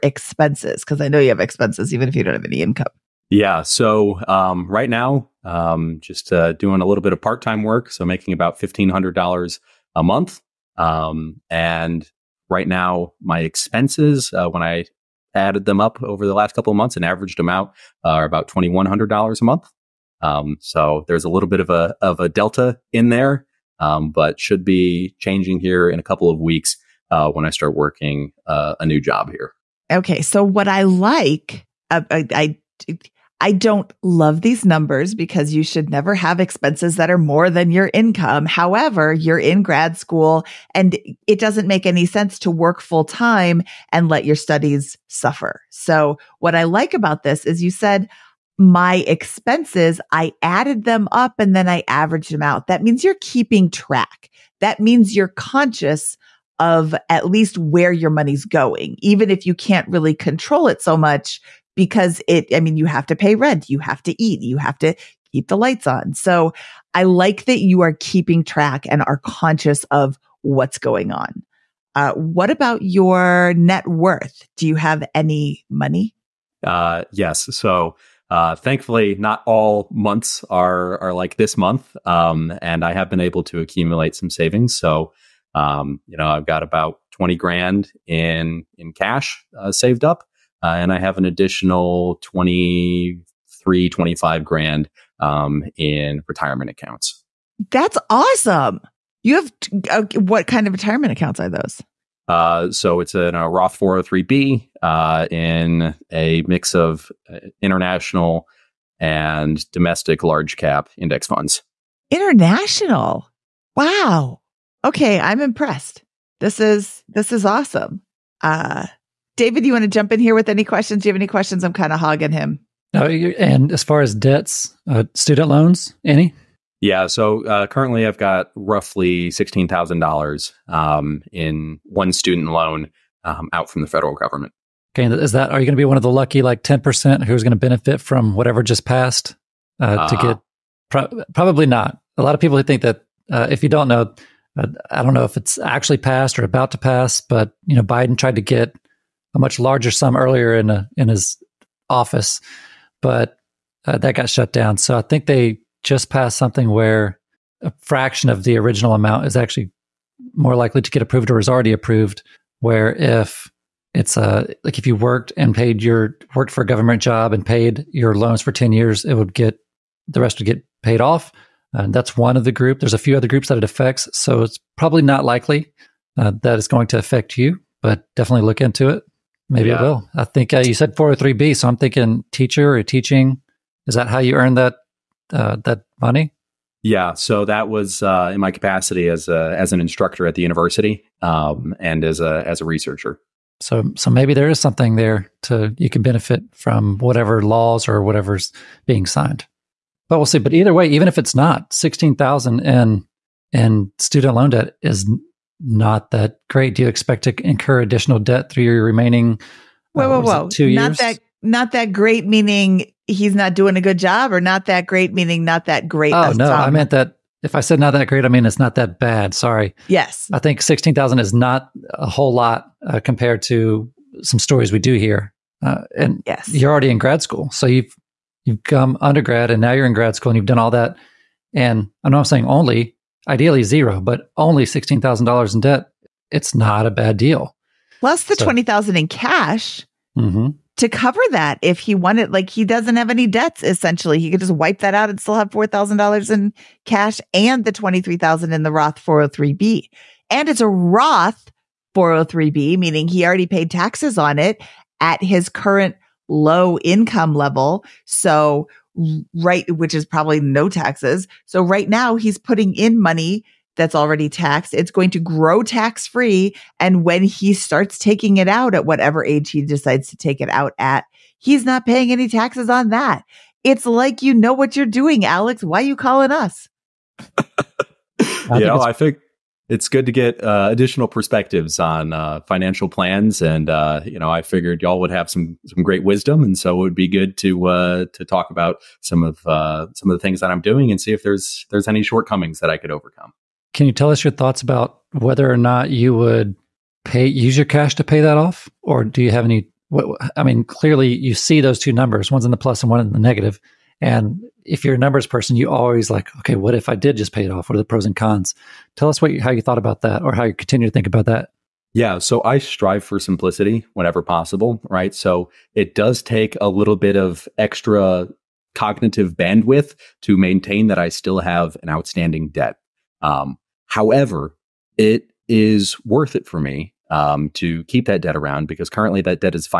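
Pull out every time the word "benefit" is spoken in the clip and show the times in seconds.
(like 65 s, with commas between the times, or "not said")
137 s, 196 s.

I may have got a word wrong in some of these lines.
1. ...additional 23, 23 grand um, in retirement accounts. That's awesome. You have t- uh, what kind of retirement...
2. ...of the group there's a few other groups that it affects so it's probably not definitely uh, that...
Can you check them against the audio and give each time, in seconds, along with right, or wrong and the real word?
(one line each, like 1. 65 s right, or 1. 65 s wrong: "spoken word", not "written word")
1. 91 s wrong: "25", not "23"
2. 172 s wrong: "likely", not "definitely".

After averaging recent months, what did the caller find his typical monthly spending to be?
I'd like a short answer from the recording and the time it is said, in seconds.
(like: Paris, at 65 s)
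$2100, at 18 s.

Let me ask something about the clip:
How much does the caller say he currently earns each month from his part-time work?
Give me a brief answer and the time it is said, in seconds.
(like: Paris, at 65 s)
$1500, at 8 s.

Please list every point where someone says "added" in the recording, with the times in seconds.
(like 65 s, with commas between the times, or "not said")
15 s, 50 s.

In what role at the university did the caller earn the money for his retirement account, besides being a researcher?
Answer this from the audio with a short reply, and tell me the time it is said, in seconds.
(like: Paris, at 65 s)
instructor, at 189 s.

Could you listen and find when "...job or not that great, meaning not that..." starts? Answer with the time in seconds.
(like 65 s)
213 s.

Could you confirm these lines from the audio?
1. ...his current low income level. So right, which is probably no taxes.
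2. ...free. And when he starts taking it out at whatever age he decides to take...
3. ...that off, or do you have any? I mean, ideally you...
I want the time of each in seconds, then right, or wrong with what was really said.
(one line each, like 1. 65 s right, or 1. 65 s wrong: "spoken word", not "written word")
1. 255 s right
2. 266 s right
3. 298 s wrong: "clearly", not "ideally".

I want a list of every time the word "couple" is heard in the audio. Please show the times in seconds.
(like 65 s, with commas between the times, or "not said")
16 s, 26 s.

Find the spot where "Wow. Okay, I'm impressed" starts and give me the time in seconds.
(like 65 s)
113 s.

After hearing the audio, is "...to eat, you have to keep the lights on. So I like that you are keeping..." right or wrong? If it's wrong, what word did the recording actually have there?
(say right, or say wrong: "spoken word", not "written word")
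right.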